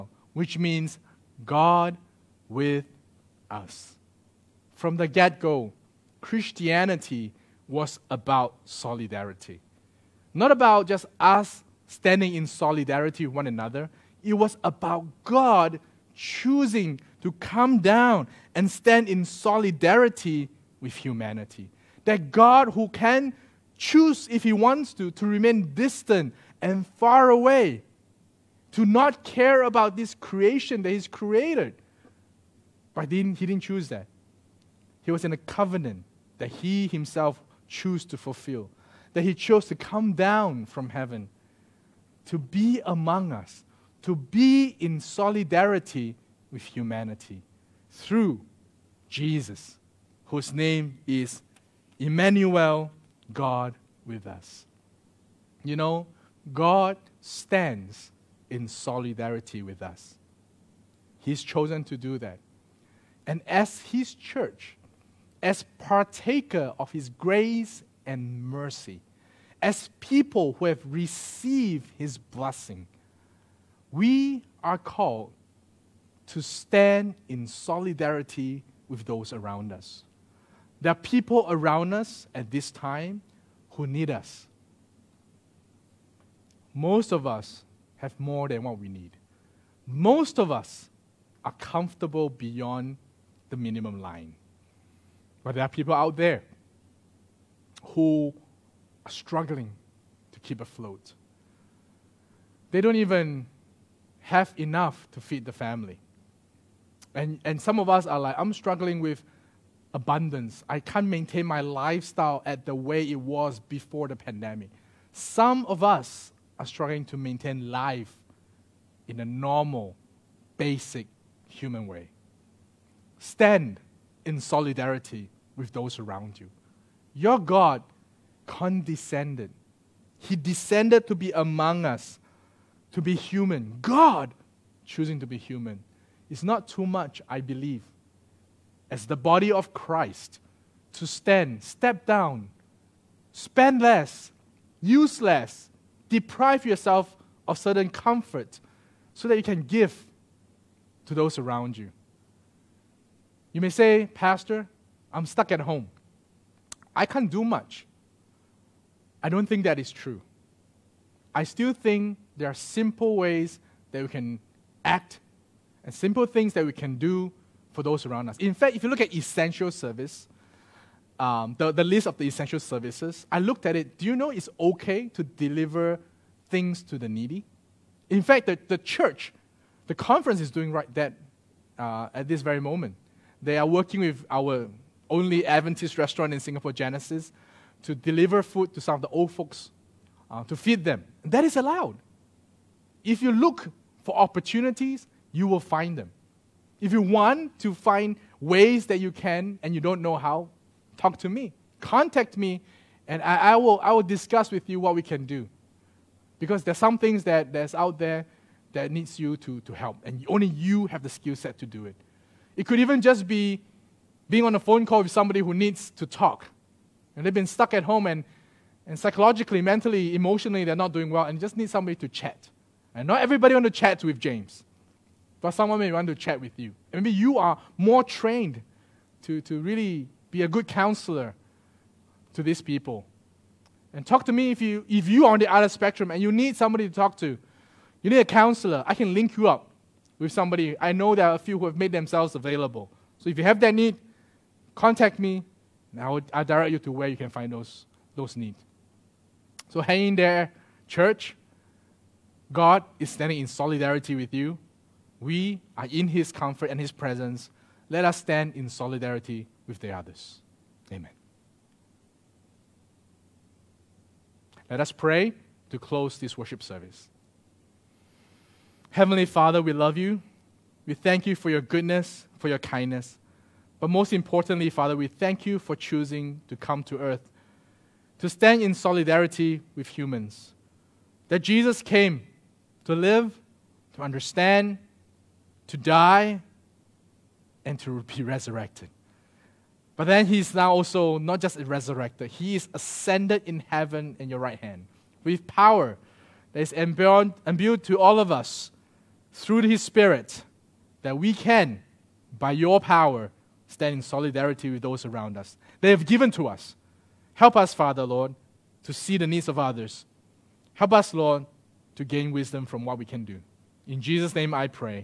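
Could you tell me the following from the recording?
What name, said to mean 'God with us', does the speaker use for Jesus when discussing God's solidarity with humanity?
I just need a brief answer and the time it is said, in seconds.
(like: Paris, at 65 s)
Emmanuel, at 51 s.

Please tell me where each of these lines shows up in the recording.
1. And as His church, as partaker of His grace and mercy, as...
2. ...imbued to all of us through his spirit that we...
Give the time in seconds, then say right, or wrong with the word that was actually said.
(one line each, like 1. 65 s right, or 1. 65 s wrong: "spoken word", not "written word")
1. 63 s right
2. 296 s right.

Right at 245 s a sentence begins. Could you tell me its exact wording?
I will direct you to where you can find those, those needs.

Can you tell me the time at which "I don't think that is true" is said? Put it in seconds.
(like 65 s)
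159 s.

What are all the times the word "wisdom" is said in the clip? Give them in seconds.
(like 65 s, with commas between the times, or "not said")
312 s.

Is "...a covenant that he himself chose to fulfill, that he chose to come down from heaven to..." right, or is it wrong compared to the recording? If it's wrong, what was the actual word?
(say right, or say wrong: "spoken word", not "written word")
right.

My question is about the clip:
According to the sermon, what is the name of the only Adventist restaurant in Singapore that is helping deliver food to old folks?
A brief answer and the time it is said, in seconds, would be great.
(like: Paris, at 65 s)
Genesis, at 186 s.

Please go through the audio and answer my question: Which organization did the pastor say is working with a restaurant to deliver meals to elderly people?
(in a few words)
the conference.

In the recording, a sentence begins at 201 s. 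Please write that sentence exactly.
Contact me, and I, I will, I will discuss with you what we can do.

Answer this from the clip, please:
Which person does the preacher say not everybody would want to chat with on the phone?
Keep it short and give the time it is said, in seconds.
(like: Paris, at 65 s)
James, at 224 s.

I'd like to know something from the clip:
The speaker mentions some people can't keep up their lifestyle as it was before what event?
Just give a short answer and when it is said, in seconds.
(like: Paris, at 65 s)
the pandemic, at 114 s.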